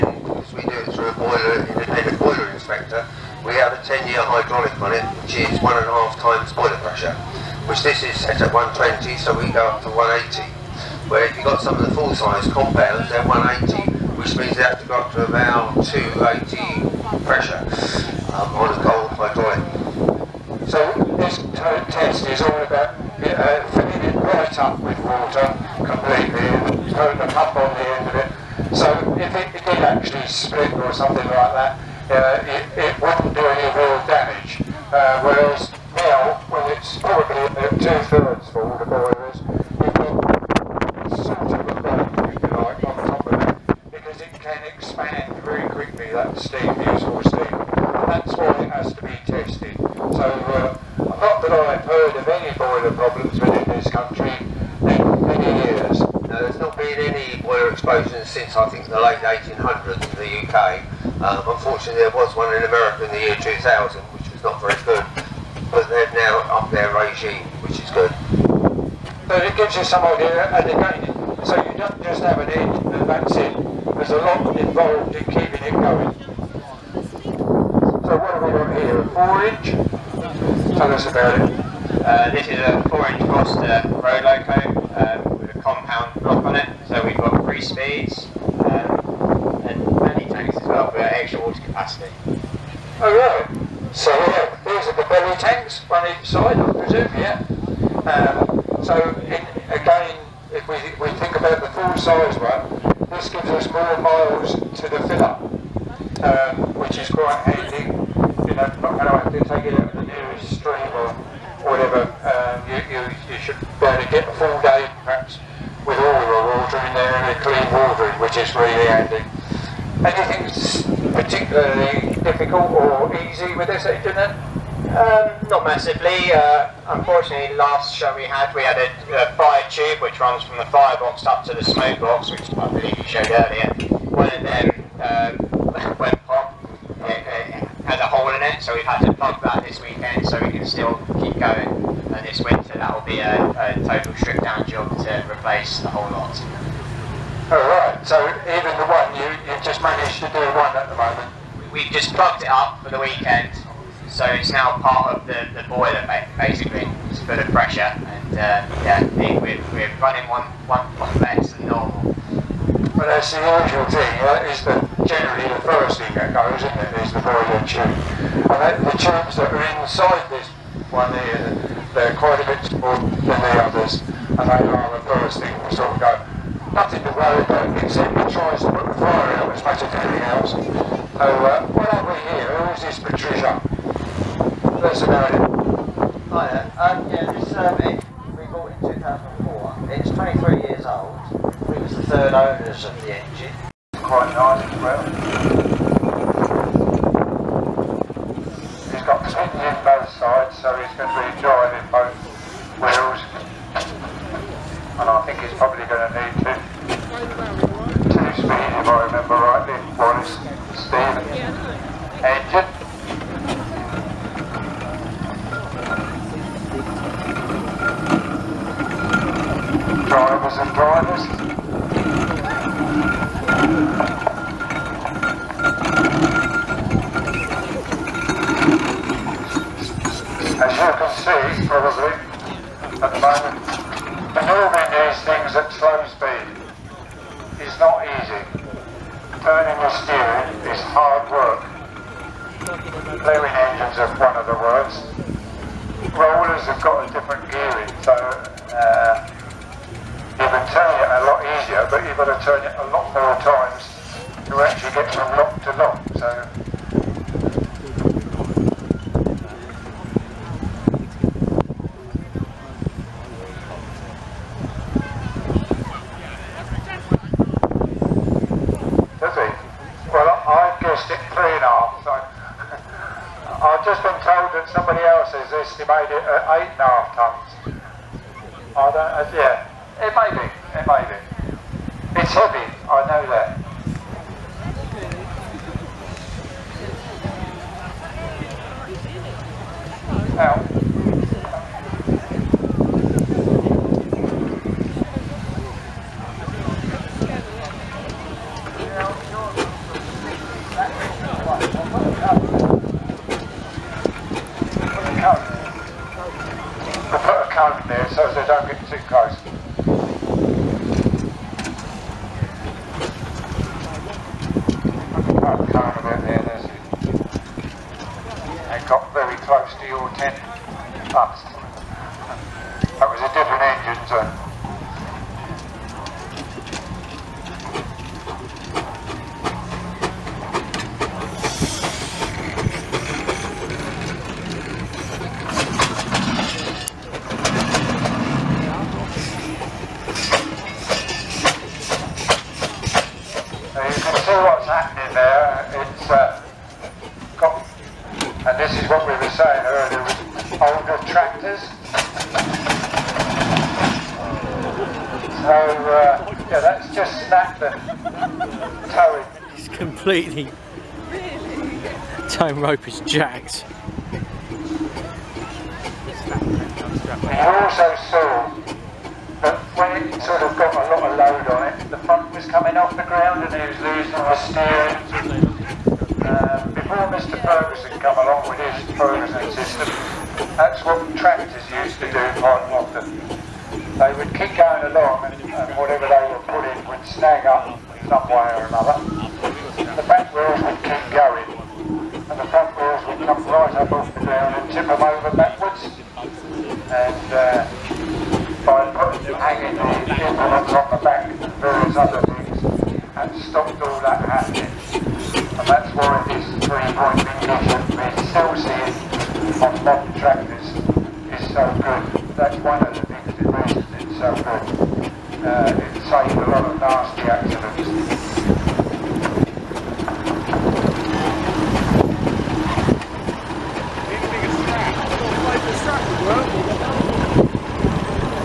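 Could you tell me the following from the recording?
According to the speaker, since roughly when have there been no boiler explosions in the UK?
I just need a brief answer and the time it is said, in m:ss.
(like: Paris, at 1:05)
late 1800s, at 0:58.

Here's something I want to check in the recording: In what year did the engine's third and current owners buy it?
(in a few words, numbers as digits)
2004.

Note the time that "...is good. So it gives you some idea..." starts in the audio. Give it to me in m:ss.
1:07.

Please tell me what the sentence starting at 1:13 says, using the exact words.
There's a lot involved in keeping it going.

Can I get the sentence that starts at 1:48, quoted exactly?
You know, not going to have to take it out of the nearest stream or whatever.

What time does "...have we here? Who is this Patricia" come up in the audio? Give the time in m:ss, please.
3:01.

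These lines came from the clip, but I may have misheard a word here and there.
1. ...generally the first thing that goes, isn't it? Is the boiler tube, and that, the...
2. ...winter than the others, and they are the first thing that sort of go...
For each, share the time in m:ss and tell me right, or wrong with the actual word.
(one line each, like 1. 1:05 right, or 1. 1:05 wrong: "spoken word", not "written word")
1. 2:45 right
2. 2:52 wrong: "smaller", not "winter".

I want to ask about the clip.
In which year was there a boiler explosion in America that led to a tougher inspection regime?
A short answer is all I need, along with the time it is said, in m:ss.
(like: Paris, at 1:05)
2000, at 1:03.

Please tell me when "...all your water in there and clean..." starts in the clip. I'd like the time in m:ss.
1:55.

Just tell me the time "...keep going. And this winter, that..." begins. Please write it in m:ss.
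2:21.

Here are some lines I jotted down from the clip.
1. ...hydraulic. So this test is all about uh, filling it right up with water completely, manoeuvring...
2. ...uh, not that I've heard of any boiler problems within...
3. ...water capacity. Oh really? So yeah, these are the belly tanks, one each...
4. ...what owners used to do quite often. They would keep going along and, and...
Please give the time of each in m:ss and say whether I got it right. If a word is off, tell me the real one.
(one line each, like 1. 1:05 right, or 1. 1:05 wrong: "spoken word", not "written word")
1. 0:19 wrong: "putting", not "manoeuvring"
2. 0:50 right
3. 1:31 right
4. 6:20 wrong: "tractors", not "owners".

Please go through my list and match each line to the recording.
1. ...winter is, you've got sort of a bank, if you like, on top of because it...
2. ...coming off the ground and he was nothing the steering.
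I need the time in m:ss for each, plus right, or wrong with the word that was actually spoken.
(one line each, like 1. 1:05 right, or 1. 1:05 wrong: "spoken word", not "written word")
1. 0:38 wrong: "boiler", not "winter"
2. 6:12 wrong: "losing", not "nothing".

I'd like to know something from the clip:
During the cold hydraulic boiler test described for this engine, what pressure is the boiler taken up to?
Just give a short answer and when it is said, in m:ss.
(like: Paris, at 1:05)
180, at 0:09.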